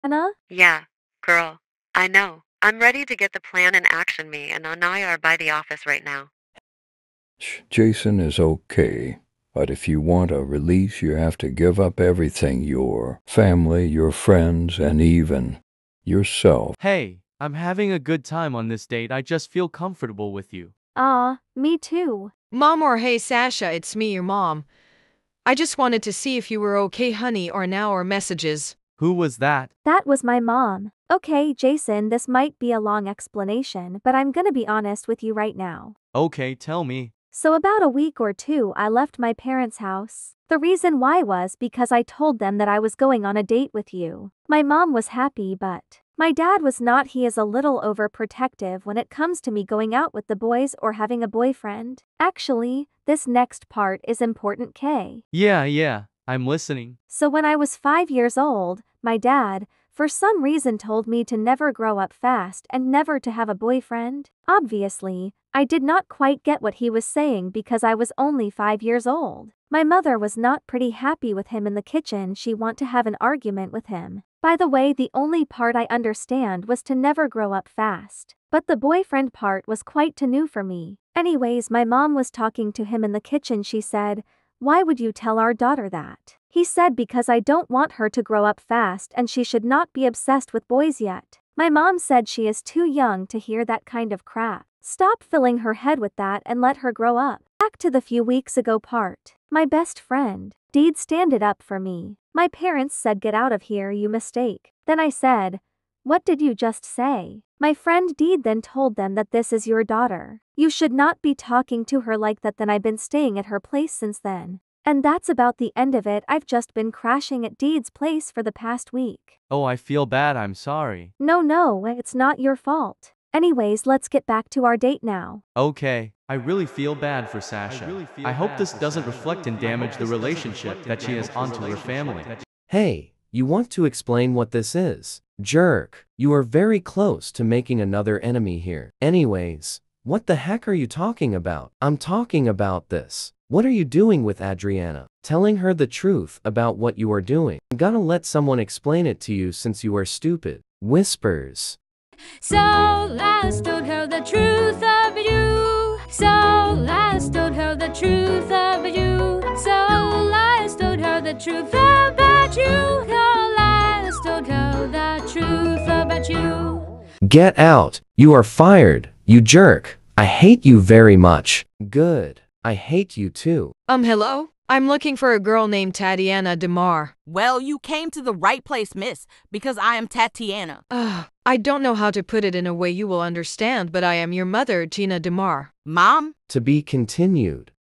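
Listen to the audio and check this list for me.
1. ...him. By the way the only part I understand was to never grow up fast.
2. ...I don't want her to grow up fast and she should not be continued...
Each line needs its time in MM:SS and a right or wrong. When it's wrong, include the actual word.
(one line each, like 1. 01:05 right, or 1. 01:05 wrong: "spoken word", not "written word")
1. 01:13 right
2. 01:27 wrong: "obsessed", not "continued".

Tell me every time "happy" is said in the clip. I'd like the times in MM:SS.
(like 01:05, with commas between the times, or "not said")
00:45, 01:10.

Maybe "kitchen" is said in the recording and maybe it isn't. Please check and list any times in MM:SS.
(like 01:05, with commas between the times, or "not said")
01:11, 01:23.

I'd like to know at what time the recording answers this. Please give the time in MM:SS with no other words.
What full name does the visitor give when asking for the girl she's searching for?
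02:55.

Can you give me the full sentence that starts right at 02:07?
I, really I hope this doesn't Sasha.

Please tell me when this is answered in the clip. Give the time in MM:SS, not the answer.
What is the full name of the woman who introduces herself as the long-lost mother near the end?
03:04.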